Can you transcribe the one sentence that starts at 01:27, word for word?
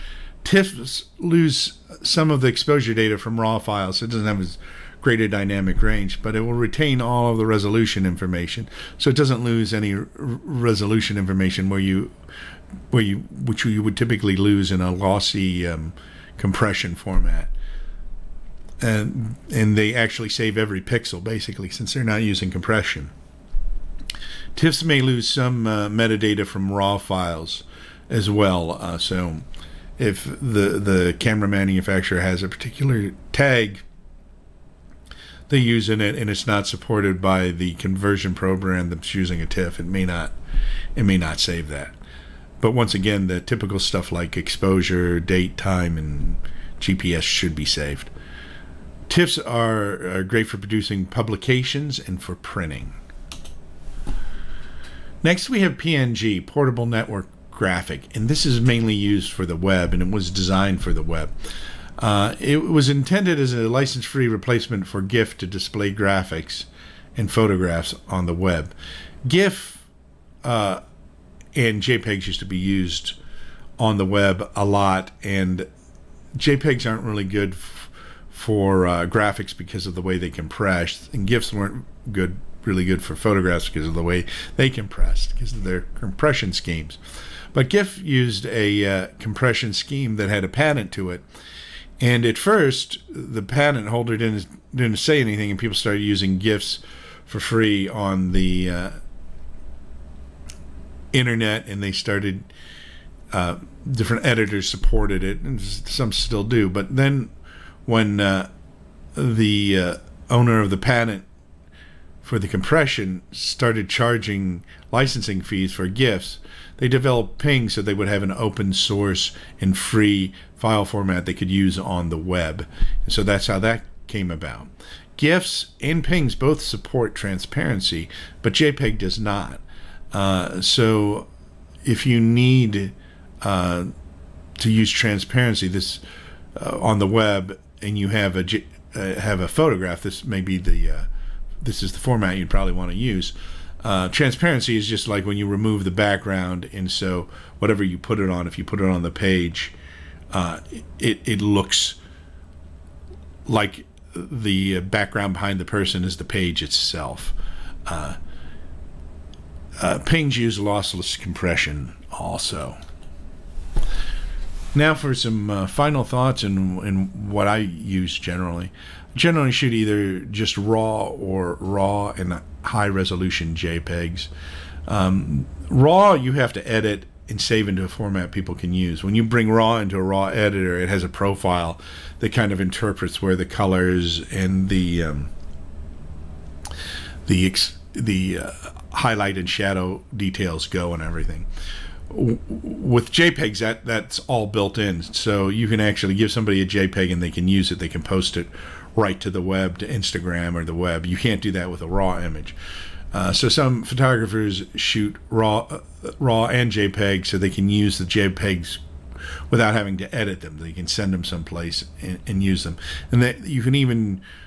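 But GIF used a uh, compression scheme that had a patent to it.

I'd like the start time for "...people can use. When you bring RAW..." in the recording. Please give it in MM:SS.
02:58.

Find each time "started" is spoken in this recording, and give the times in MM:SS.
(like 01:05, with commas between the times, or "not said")
01:35, 01:41, 01:53.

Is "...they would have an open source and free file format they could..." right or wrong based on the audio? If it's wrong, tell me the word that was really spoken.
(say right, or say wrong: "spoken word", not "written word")
right.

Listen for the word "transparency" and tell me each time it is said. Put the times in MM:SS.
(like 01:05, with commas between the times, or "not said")
02:07, 02:14, 02:24.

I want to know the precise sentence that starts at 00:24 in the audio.
TIFFs may lose some uh, metadata from raw files as well.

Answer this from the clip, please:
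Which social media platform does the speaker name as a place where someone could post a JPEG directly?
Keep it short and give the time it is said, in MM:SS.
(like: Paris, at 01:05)
Instagram, at 03:19.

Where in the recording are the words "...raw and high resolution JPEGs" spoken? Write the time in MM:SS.
02:51.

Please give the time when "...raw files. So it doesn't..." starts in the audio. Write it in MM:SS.
00:03.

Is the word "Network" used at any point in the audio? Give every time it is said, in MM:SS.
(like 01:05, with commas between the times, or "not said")
00:56.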